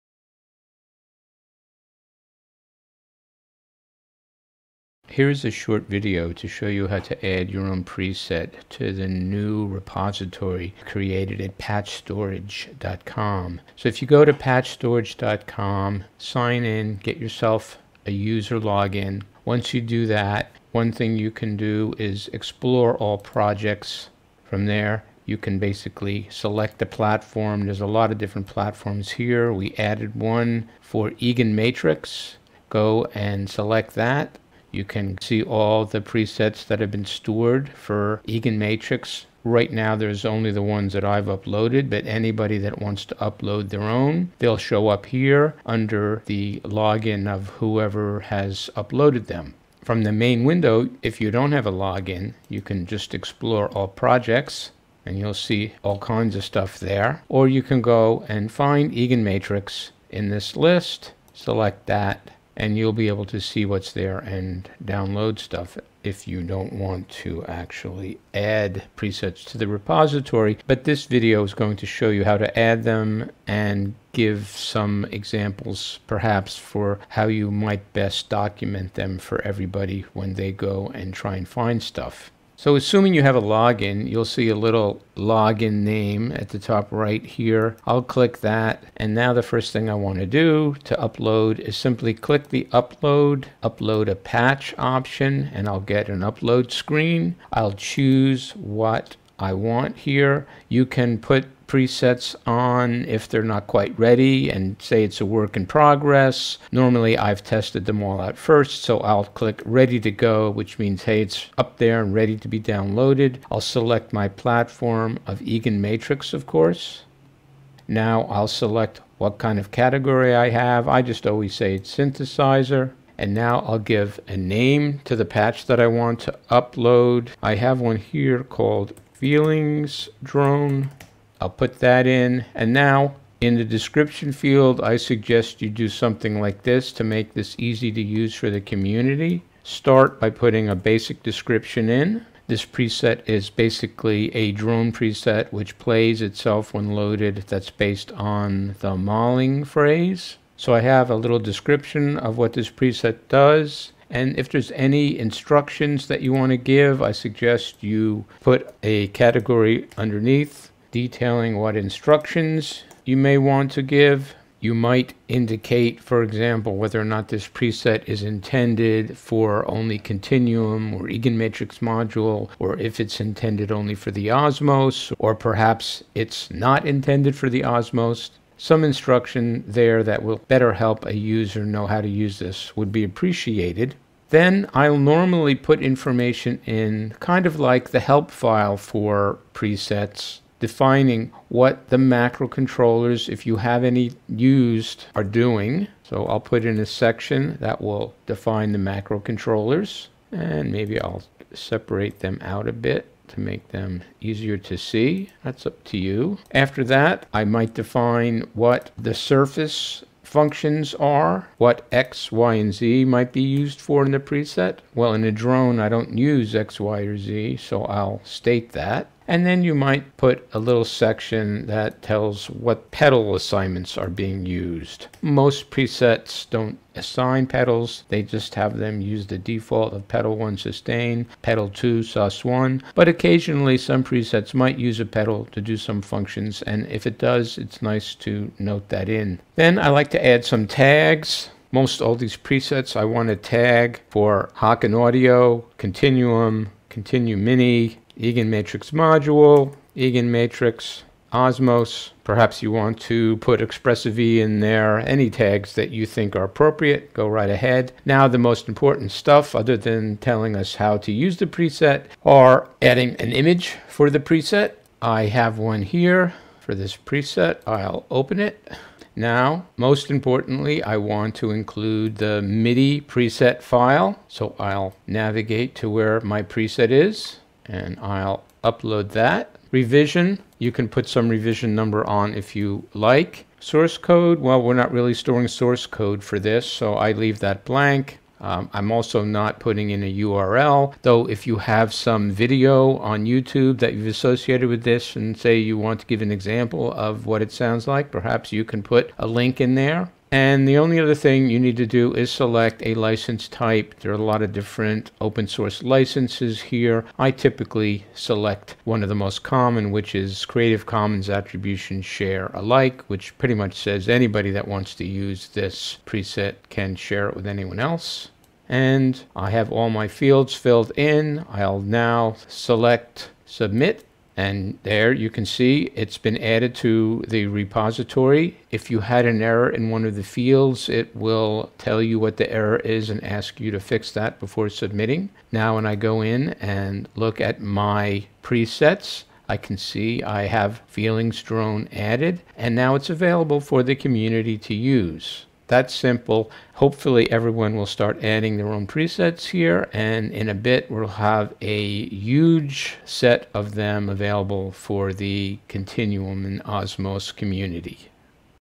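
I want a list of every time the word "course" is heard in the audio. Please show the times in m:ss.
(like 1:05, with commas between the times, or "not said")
1:56.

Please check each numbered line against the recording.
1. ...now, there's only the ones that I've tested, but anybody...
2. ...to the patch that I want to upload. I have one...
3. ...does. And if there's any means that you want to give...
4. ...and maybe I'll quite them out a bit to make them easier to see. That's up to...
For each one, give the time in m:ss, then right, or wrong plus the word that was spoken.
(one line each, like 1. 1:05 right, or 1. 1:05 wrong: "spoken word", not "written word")
1. 0:39 wrong: "uploaded", not "tested"
2. 2:05 right
3. 2:33 wrong: "instructions", not "means"
4. 3:20 wrong: "separate", not "quite".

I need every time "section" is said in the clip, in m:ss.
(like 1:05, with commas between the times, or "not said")
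3:16, 3:40.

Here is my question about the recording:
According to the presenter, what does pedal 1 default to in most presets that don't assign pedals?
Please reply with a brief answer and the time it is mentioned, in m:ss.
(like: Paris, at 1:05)
Sustain, at 3:50.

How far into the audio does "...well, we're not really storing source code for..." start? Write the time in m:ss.
4:44.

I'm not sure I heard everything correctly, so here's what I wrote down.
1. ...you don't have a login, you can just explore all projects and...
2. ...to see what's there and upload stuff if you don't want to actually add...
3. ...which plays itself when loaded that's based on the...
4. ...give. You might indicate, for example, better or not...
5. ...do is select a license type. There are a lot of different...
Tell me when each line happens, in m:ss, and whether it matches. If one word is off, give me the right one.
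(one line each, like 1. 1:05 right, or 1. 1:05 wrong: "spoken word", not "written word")
1. 0:51 right
2. 1:03 wrong: "download", not "upload"
3. 2:25 right
4. 2:43 wrong: "whether", not "better"
5. 5:01 right.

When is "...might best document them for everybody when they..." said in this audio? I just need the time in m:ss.
1:17.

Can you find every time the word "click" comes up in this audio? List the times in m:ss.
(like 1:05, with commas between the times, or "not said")
1:28, 1:32, 1:49.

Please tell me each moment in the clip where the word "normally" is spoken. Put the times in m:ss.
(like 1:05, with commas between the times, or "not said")
1:46, 3:04.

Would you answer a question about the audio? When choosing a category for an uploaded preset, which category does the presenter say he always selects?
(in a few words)
Synthesizer.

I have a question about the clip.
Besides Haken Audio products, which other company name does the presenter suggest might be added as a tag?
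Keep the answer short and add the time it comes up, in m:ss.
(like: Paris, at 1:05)
Expressive E, at 4:13.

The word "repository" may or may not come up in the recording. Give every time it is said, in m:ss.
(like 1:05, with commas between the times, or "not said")
0:09, 1:09, 5:27.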